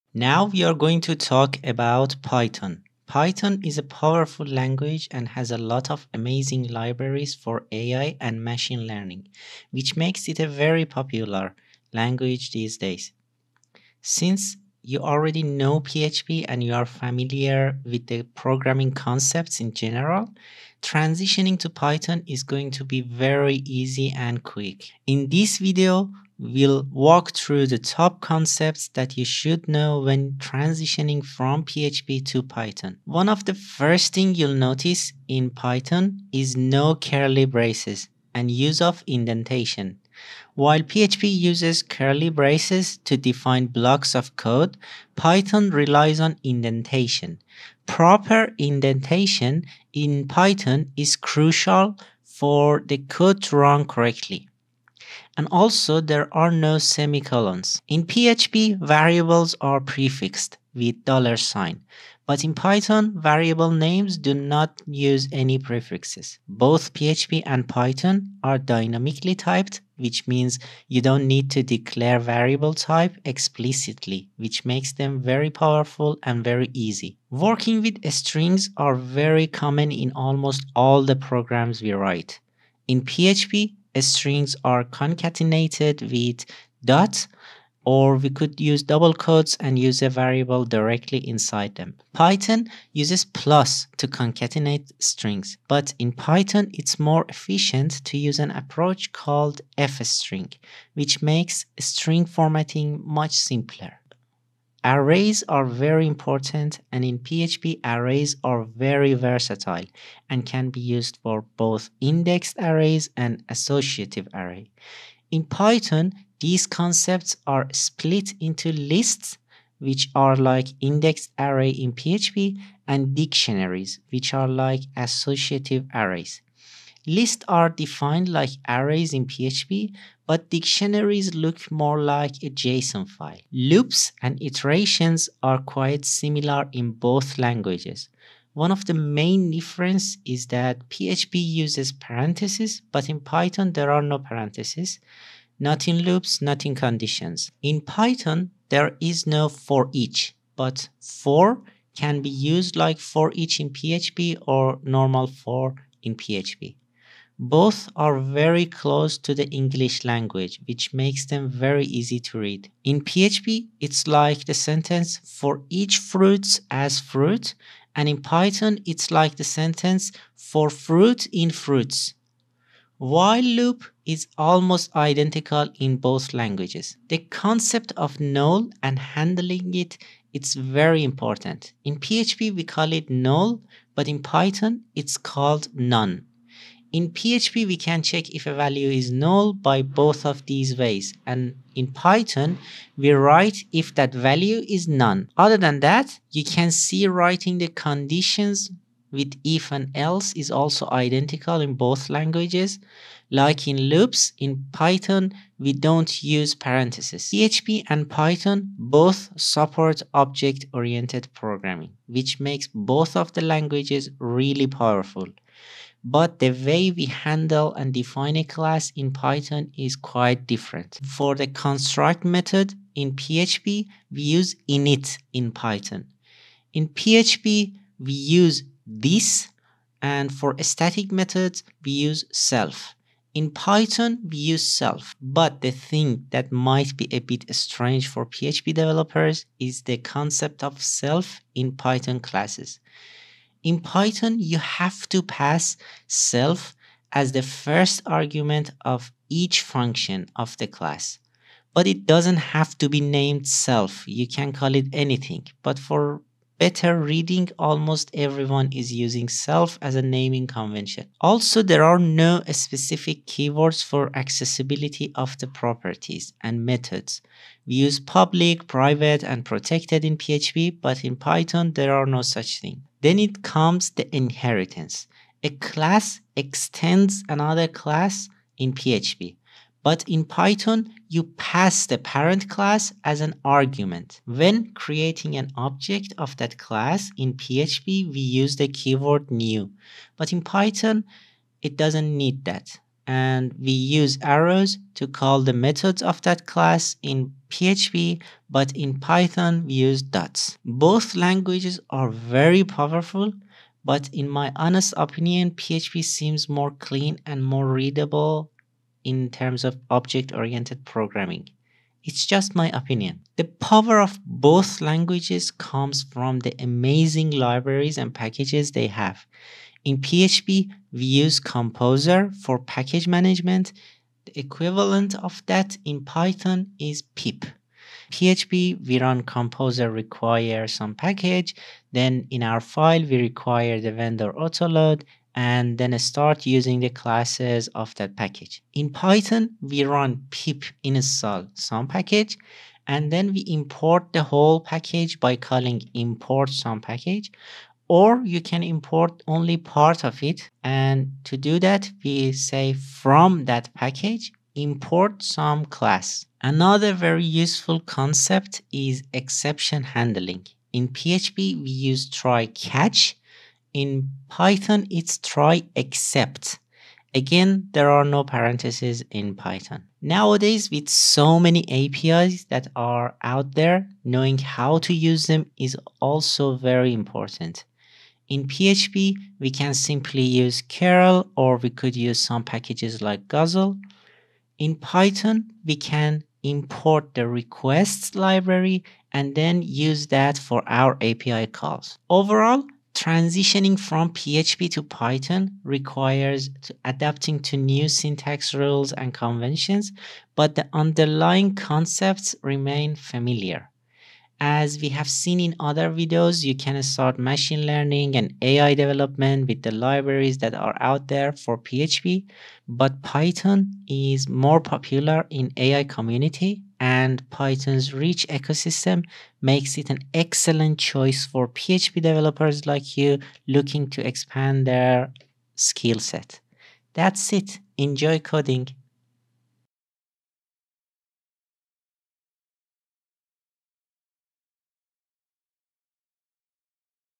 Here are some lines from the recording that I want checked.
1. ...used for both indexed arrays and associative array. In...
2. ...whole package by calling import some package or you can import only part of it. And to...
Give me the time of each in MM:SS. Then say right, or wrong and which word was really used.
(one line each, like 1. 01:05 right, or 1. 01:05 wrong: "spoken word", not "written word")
1. 01:50 right
2. 05:44 right.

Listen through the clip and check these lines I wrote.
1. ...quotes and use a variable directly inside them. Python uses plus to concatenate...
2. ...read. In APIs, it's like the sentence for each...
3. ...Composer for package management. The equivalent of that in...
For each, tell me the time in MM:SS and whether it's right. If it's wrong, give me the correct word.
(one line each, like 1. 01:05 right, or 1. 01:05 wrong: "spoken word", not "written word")
1. 01:29 right
2. 02:42 wrong: "PHP", not "APIs"
3. 05:21 right.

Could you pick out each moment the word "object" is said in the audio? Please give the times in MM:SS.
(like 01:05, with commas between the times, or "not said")
03:30, 04:45, 05:09.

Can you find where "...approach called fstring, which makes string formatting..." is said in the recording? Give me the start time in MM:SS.
01:38.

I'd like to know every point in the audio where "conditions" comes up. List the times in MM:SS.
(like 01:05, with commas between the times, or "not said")
02:26, 03:17.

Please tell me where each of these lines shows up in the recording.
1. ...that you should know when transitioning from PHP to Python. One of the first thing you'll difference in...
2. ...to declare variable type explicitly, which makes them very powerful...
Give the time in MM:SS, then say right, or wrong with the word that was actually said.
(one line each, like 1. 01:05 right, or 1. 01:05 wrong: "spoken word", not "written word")
1. 00:28 wrong: "notice", not "difference"
2. 01:11 right.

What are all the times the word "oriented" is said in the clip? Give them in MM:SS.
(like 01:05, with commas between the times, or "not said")
03:30, 05:09.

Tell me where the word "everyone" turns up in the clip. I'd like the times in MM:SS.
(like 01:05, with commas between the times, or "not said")
04:18.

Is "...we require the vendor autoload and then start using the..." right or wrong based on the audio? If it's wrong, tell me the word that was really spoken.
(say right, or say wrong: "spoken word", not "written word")
right.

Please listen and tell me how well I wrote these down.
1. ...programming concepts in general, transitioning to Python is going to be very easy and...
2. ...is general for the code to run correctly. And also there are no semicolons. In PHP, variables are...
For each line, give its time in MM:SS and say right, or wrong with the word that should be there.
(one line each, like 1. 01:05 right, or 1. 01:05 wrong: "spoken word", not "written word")
1. 00:18 right
2. 00:50 wrong: "crucial", not "general".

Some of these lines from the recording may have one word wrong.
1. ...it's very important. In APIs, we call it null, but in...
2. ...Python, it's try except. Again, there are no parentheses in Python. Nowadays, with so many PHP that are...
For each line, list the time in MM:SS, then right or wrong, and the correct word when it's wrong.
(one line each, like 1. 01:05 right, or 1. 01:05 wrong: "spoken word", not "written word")
1. 03:00 wrong: "PHP", not "APIs"
2. 06:04 wrong: "APIs", not "PHP".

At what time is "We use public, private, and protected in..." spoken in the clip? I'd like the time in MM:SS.
04:27.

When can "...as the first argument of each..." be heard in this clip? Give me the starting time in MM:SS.
04:07.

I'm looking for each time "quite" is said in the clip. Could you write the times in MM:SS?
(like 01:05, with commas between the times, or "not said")
02:15, 03:39.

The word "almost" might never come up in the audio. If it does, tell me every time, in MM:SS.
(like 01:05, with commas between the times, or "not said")
01:20, 02:54, 04:17.